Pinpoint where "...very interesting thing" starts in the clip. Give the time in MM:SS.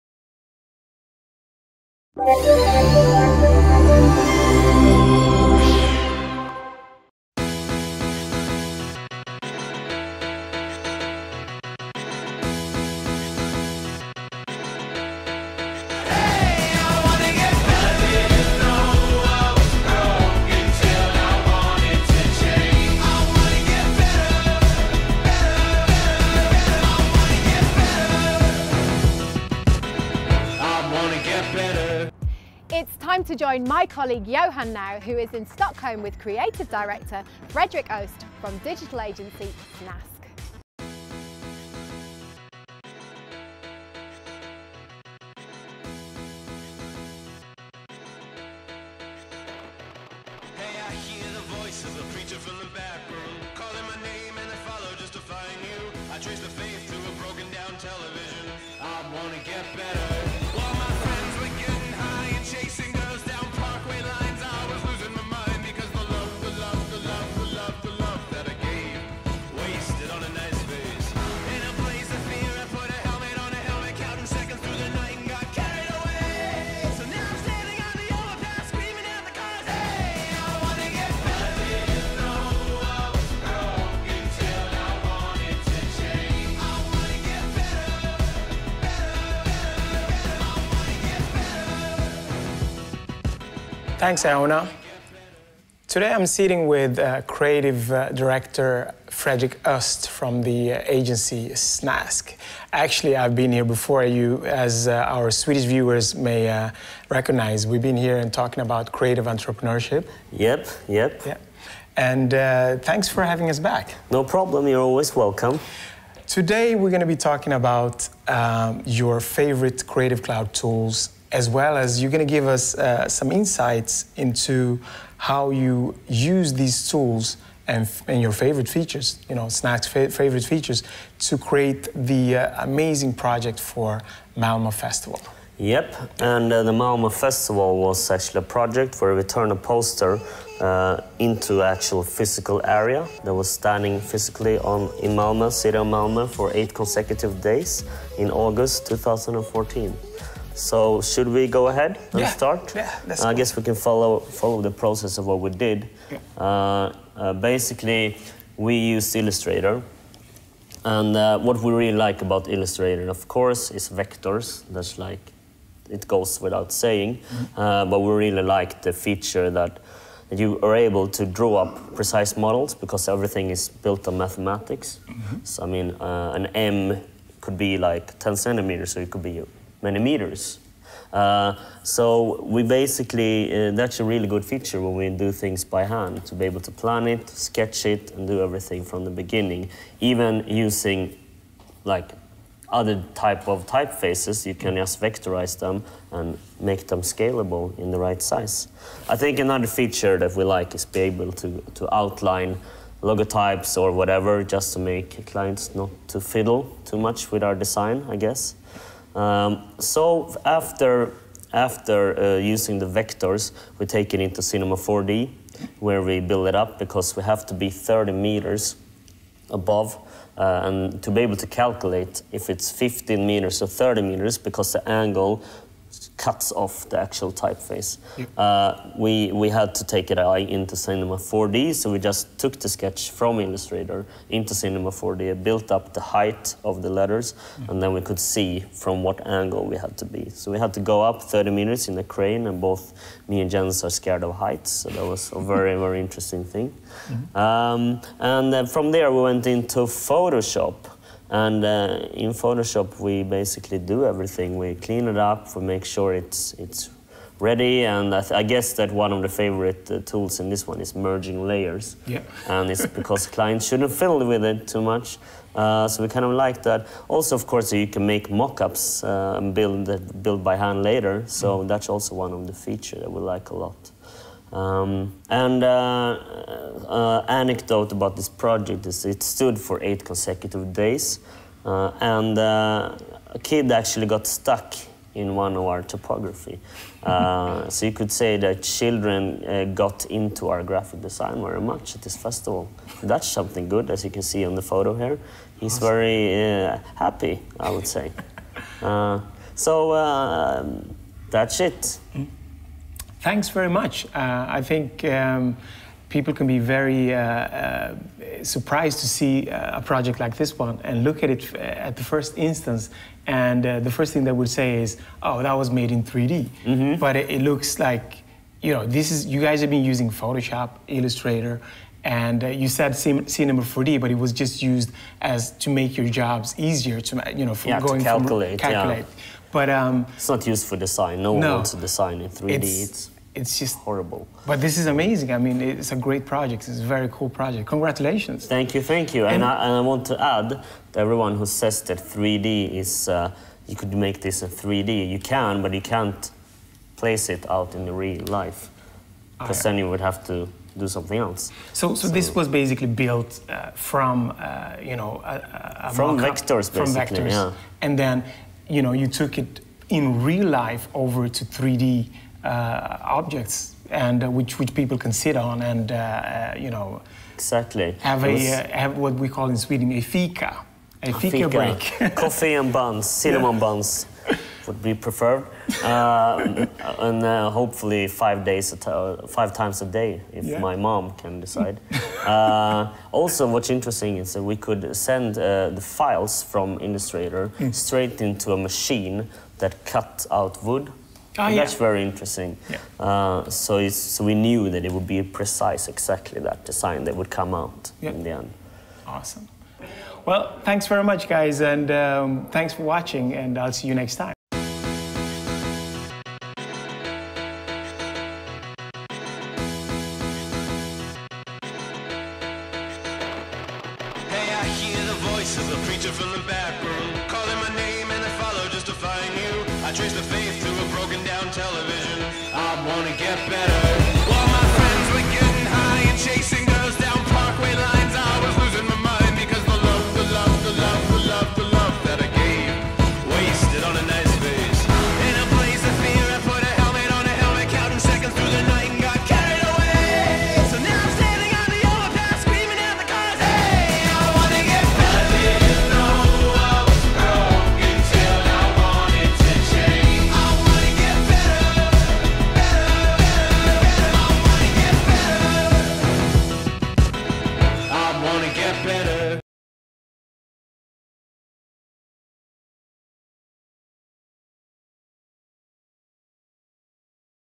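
04:05.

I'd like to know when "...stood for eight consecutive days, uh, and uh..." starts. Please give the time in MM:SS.
04:39.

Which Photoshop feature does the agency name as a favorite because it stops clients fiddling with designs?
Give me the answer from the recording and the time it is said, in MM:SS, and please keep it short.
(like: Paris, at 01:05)
Merging layers, at 04:20.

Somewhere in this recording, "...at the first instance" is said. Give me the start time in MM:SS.
05:11.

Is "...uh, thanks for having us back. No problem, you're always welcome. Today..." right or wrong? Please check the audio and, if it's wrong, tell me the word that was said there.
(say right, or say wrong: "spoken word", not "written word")
right.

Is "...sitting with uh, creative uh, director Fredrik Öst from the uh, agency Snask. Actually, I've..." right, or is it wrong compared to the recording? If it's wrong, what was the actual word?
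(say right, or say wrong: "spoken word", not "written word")
right.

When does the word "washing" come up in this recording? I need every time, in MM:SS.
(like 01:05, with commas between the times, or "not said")
not said.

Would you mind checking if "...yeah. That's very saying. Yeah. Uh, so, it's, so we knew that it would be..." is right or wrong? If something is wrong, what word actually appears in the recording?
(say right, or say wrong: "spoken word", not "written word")
wrong: "interesting", not "saying".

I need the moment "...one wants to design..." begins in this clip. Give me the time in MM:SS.
05:31.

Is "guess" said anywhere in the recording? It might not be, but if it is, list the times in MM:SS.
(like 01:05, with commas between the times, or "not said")
02:33, 03:28, 04:18.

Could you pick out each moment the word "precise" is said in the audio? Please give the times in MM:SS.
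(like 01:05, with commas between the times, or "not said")
02:51, 06:35.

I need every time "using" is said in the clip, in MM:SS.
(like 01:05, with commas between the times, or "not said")
03:10, 03:32, 05:19.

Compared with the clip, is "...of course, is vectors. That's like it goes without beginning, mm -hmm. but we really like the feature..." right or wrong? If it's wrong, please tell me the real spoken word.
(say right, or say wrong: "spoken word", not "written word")
wrong: "saying", not "beginning".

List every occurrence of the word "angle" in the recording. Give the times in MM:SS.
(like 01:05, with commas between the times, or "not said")
03:44, 03:59.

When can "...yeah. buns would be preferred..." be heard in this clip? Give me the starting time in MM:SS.
06:13.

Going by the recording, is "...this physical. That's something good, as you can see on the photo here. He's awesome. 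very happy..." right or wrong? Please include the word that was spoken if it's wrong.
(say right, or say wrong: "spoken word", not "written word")
wrong: "festival", not "physical".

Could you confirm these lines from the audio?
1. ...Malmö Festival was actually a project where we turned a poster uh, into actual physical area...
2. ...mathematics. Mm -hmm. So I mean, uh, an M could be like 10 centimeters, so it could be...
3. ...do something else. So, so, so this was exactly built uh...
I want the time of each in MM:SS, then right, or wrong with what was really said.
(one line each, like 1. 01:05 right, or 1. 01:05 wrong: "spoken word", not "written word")
1. 02:16 right
2. 02:54 right
3. 05:50 wrong: "basically", not "exactly".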